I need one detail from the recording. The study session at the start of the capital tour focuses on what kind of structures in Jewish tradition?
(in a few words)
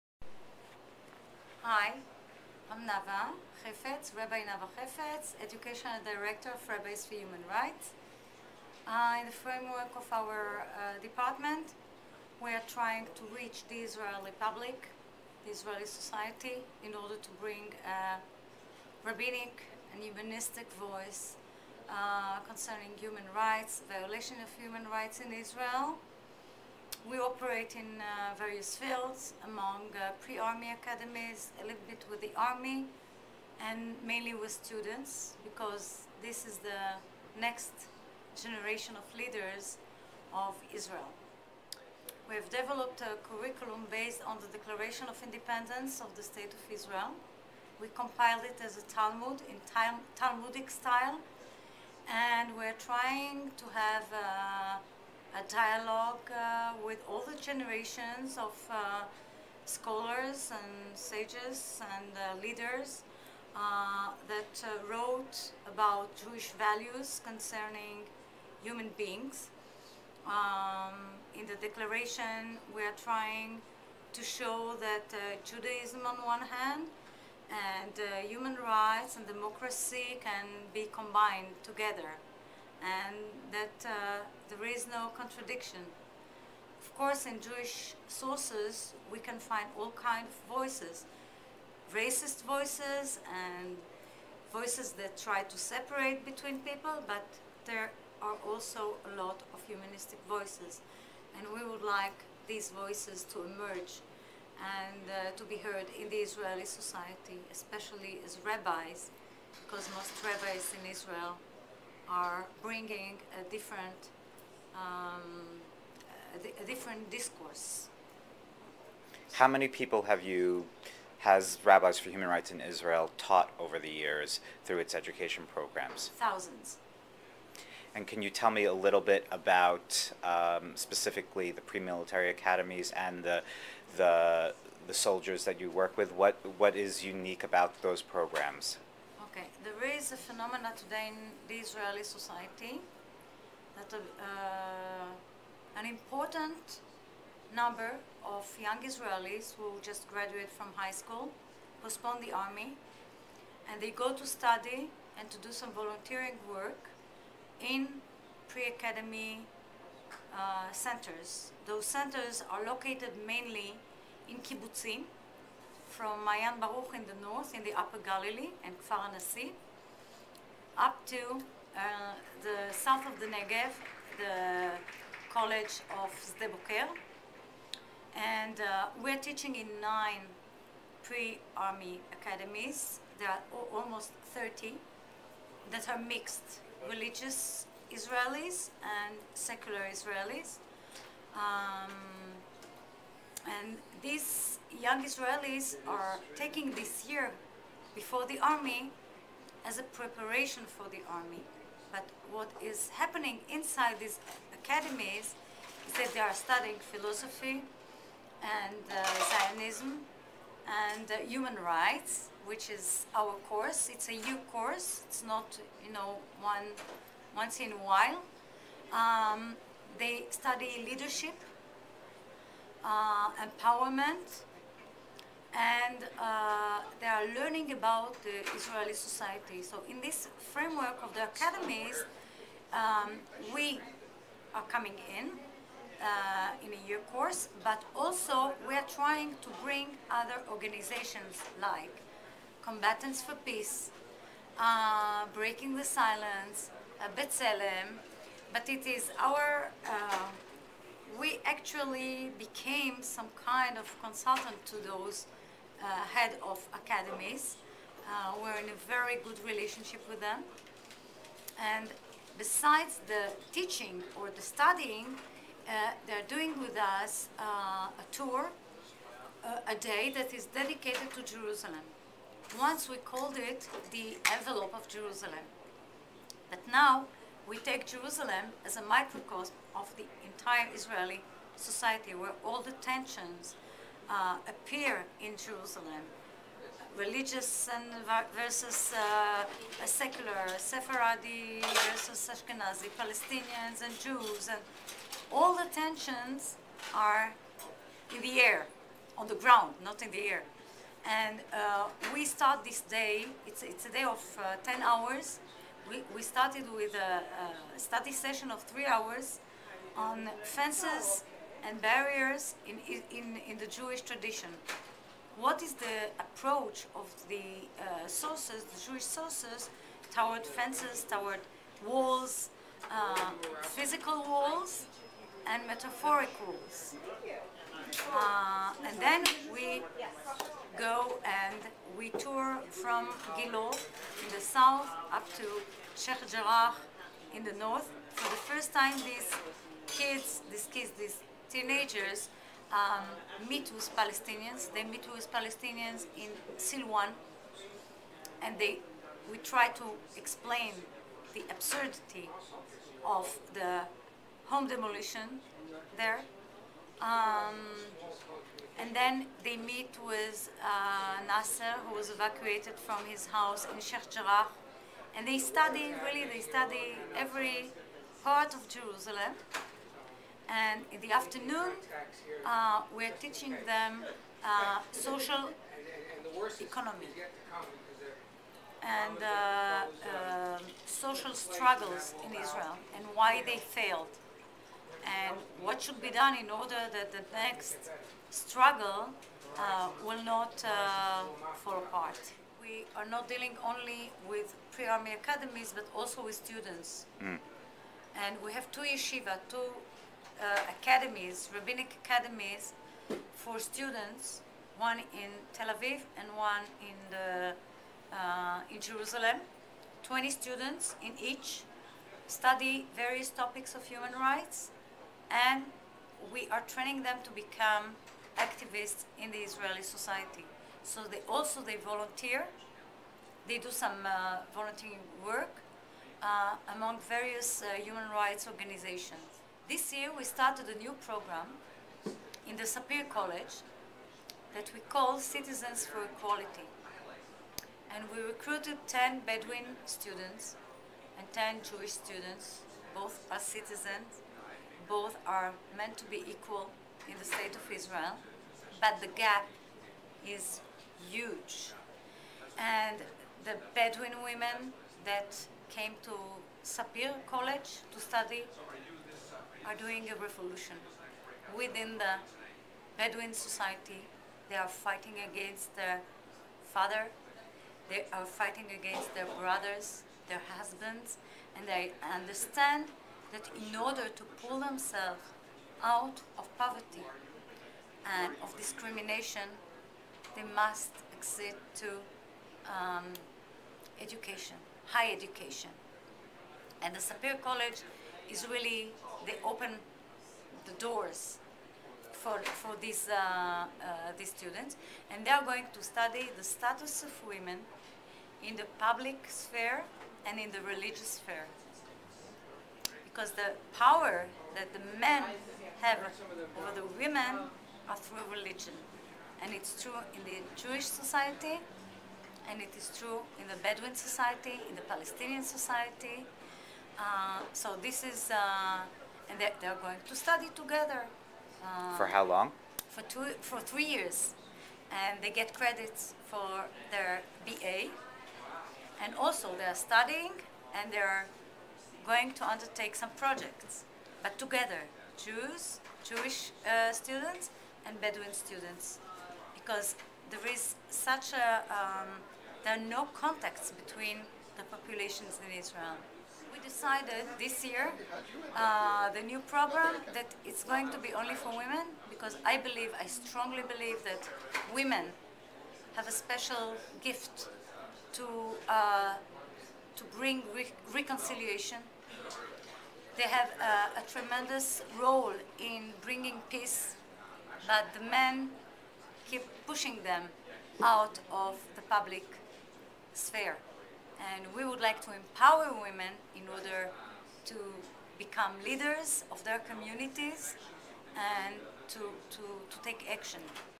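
Fences and barriers.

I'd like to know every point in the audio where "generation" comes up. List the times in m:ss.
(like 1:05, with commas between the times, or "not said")
0:38, 0:57.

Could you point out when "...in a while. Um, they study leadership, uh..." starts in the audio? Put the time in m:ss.
3:37.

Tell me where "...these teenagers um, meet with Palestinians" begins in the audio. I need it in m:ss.
5:40.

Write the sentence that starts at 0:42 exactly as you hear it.
We have developed a curriculum based on the Declaration of Independence of the State of Israel.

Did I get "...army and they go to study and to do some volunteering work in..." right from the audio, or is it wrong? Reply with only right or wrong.
right.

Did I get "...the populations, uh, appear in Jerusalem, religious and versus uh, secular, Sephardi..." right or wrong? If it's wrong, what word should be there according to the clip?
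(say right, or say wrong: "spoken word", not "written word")
wrong: "tensions", not "populations".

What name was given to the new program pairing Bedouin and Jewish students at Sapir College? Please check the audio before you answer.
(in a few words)
Citizens for Equality.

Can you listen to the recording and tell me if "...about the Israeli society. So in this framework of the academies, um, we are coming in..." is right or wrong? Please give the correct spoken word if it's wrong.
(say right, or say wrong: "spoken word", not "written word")
right.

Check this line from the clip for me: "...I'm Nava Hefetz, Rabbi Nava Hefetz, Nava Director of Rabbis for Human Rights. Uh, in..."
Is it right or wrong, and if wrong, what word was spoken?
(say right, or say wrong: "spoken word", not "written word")
wrong: "Educational", not "Nava".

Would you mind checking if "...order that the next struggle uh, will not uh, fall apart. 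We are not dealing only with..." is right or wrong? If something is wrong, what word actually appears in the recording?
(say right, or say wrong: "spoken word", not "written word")
right.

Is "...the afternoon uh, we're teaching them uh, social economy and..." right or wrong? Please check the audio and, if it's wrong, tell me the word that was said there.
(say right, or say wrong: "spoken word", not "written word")
right.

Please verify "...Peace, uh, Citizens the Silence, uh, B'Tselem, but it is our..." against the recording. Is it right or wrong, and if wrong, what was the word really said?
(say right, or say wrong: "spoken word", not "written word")
wrong: "Breaking", not "Citizens".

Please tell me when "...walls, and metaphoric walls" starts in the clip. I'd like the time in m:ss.
5:24.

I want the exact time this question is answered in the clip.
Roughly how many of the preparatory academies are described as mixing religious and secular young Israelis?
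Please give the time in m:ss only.
3:04.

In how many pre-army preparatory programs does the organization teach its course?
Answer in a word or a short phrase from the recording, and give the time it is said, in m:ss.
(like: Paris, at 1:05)
9, at 2:59.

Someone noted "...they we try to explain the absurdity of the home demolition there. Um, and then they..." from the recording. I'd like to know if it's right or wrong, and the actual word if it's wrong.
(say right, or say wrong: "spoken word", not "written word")
right.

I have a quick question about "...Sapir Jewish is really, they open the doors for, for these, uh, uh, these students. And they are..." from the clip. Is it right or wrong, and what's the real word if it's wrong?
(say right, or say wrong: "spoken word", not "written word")
wrong: "College", not "Jewish".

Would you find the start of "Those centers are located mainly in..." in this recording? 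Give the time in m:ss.
2:41.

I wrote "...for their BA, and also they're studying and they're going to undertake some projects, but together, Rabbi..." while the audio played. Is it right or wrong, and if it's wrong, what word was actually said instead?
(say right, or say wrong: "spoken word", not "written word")
wrong: "Jews", not "Rabbi".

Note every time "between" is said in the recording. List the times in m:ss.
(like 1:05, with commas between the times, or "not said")
1:36, 9:03.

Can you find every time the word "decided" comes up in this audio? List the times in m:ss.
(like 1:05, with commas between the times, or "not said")
9:06.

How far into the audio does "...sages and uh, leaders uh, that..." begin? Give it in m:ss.
1:00.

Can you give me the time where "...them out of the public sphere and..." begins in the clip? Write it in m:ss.
9:30.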